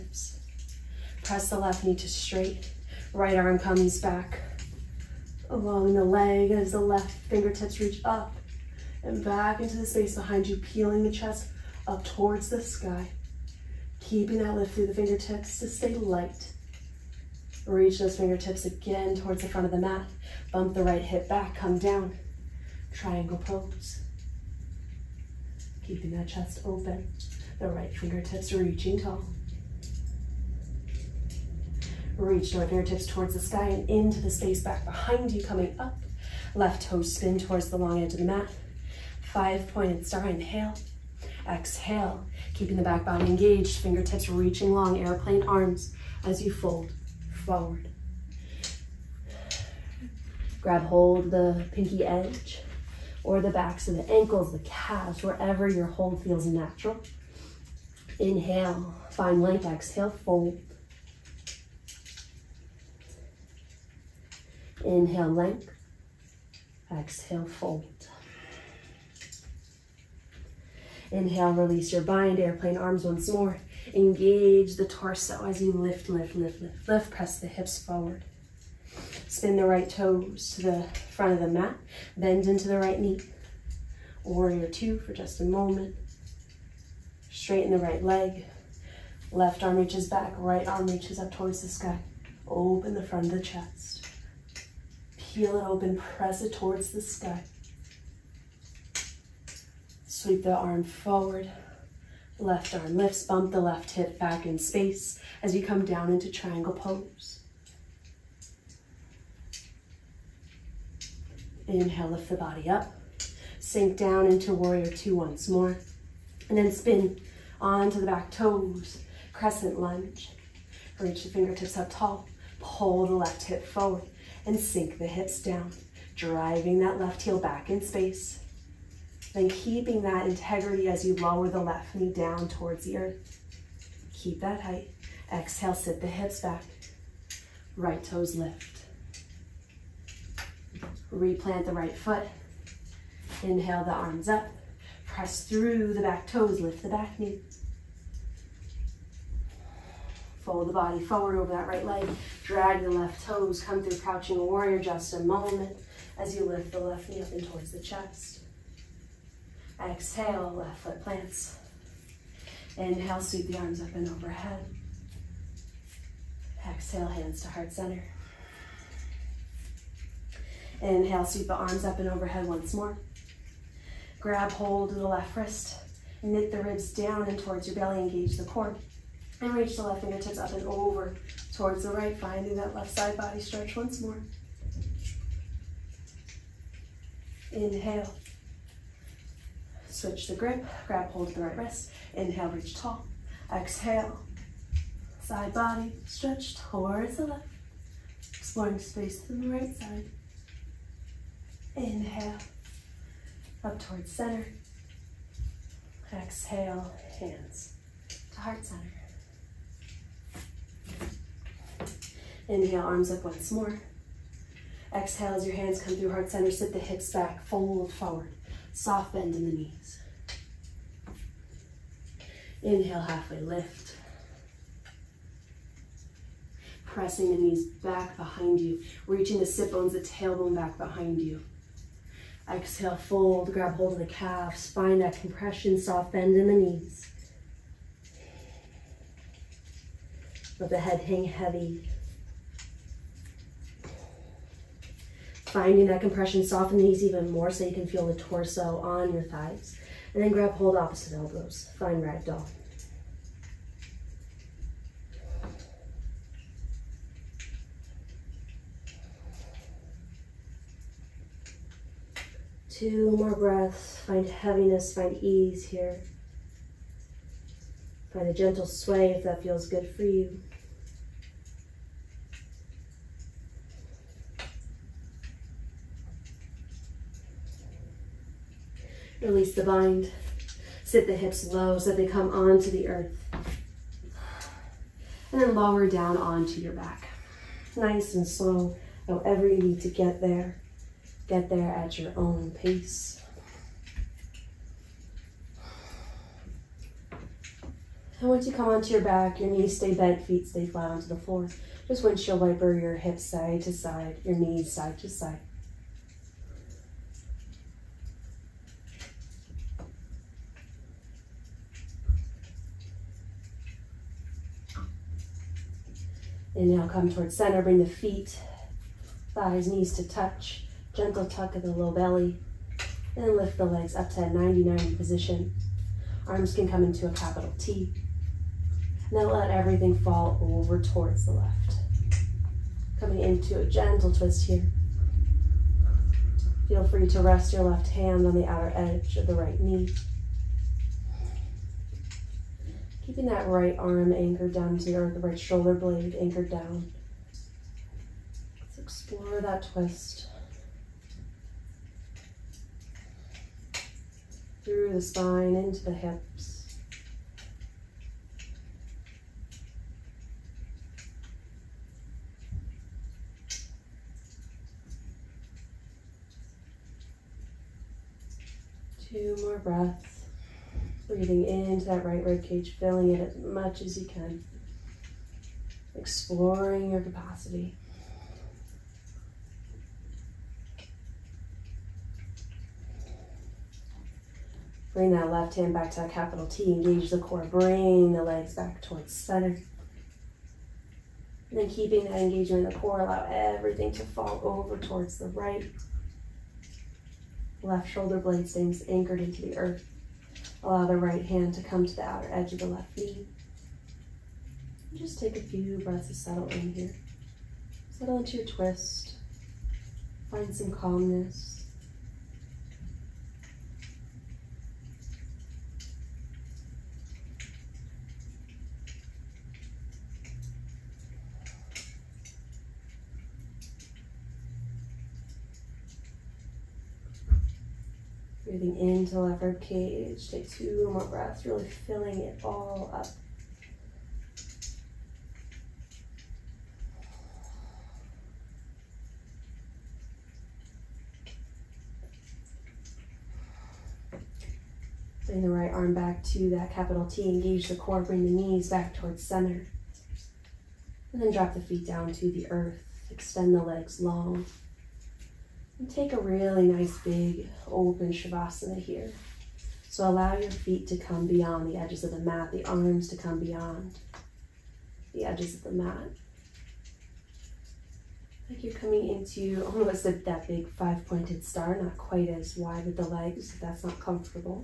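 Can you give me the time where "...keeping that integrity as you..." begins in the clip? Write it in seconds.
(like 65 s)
129 s.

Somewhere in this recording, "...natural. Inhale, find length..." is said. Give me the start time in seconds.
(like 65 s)
56 s.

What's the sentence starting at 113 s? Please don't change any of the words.
Sink down into warrior two once more.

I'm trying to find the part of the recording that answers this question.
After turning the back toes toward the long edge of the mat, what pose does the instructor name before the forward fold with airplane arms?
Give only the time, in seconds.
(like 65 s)
39 s.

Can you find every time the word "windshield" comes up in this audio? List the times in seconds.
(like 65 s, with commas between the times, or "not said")
302 s.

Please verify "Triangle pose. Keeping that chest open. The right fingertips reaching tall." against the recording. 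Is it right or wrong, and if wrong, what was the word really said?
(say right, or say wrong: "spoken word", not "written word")
right.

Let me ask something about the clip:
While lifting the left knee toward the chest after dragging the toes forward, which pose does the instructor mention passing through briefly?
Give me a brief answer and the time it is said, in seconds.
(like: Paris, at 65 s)
Crouching warrior, at 153 s.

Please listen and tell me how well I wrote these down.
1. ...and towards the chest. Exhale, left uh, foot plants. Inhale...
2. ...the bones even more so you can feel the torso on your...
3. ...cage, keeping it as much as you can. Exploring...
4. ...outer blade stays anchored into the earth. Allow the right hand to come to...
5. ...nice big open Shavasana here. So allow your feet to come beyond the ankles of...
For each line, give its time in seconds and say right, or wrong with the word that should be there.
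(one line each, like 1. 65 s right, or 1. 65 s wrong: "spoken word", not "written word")
1. 157 s right
2. 246 s wrong: "knees", not "bones"
3. 372 s wrong: "filling", not "keeping"
4. 397 s wrong: "shoulder", not "outer"
5. 456 s wrong: "edges", not "ankles".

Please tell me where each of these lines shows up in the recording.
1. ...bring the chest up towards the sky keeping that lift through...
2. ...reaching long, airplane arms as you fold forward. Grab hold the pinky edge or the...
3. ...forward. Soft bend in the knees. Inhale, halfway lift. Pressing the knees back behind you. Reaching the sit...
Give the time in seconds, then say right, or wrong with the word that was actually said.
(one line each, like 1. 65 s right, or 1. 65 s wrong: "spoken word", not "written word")
1. 10 s wrong: "peeling", not "bring"
2. 44 s right
3. 217 s right.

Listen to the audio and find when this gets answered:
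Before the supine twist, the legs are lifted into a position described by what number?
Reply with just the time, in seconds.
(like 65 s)
324 s.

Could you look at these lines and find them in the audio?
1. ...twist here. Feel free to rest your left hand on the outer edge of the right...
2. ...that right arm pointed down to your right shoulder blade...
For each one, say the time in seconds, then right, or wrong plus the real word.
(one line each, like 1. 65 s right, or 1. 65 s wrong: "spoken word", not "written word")
1. 334 s right
2. 343 s wrong: "anchored", not "pointed".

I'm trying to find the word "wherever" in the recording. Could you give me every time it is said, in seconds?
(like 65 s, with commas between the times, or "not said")
55 s.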